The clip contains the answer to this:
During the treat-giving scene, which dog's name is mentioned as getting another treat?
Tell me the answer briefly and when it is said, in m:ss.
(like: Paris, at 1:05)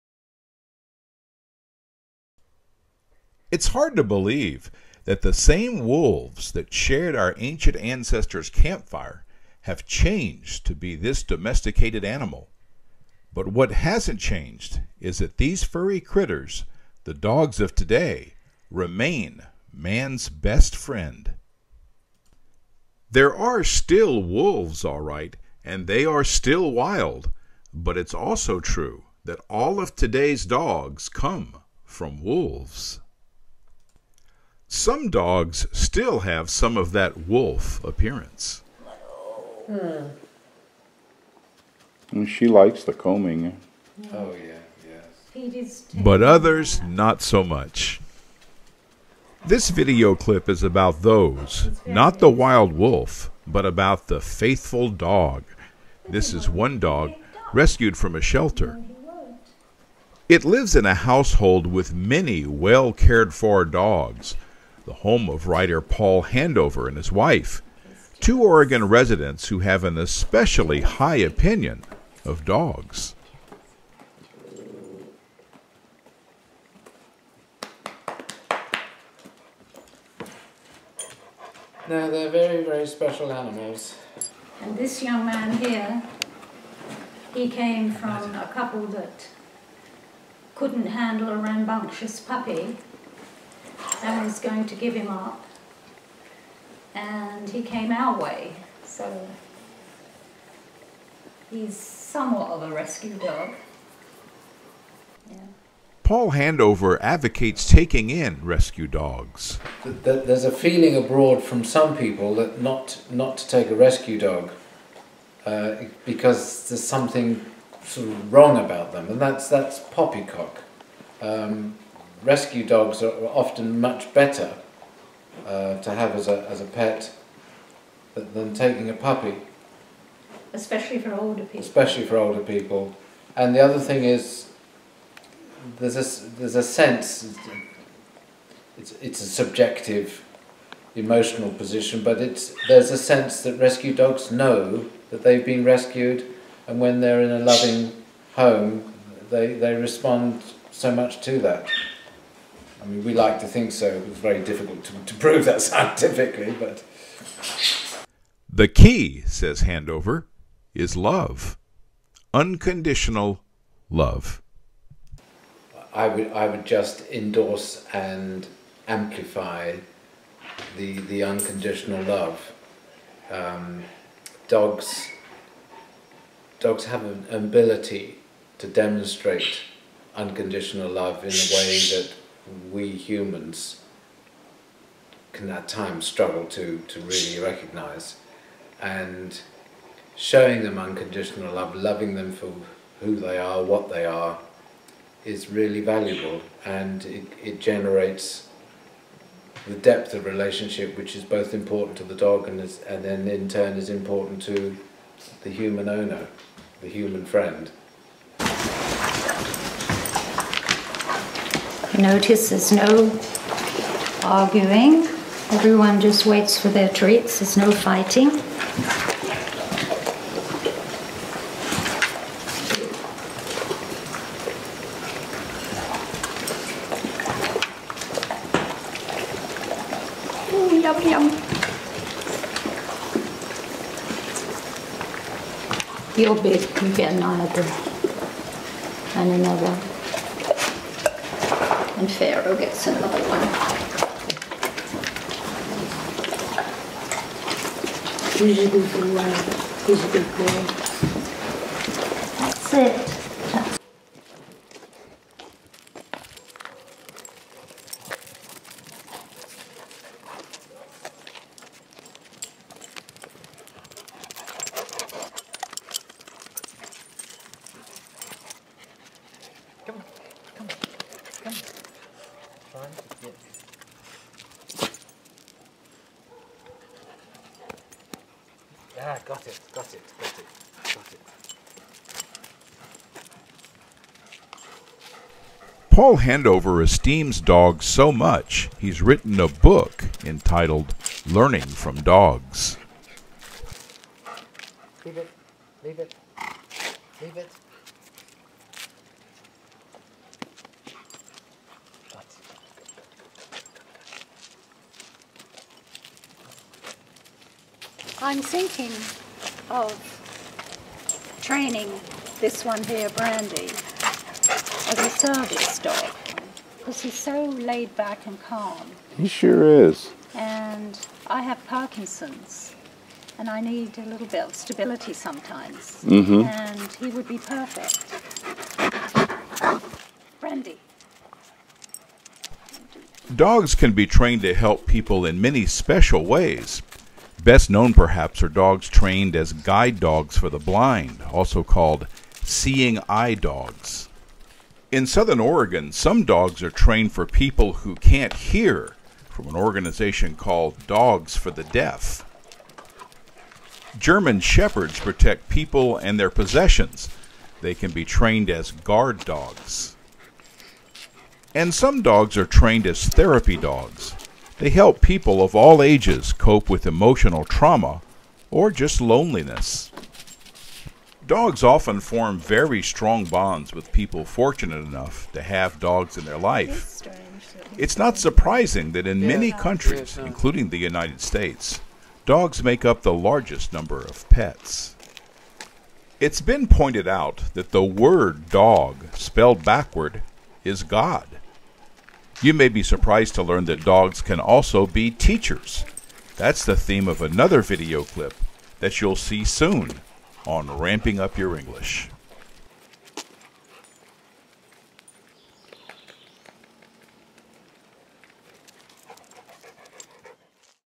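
Pharaoh, at 4:02.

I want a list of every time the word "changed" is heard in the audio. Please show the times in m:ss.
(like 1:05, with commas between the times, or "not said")
0:09, 0:14.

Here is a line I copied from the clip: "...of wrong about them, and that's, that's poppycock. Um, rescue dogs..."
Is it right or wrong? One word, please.
right.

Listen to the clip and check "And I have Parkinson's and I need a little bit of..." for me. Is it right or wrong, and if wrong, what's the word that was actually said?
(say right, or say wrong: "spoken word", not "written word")
right.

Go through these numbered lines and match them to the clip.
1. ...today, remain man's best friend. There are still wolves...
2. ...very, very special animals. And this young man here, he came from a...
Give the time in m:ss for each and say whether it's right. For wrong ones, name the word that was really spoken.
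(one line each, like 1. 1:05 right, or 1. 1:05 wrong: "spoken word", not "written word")
1. 0:17 right
2. 1:22 right.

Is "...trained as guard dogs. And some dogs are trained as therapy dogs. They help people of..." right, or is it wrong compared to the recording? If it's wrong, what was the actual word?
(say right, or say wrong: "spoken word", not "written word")
right.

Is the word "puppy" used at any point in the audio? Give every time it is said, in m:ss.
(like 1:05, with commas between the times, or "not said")
1:32, 2:08.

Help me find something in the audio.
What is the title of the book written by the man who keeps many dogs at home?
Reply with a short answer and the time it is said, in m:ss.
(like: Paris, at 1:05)
Learning from Dogs, at 4:51.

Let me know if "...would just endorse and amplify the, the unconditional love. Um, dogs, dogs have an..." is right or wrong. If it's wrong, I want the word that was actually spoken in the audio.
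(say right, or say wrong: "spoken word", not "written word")
right.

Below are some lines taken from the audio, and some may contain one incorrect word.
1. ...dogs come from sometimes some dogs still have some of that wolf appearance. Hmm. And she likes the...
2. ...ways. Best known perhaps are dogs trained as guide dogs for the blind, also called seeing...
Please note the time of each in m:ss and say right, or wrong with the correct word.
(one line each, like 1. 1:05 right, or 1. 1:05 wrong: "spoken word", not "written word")
1. 0:30 wrong: "wolves", not "sometimes"
2. 5:36 right.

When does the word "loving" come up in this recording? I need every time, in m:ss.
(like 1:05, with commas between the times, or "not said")
2:27, 3:11.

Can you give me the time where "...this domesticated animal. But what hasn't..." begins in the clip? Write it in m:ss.
0:10.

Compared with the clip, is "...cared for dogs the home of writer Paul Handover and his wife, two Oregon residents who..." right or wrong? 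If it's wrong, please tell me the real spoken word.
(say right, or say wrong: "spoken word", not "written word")
right.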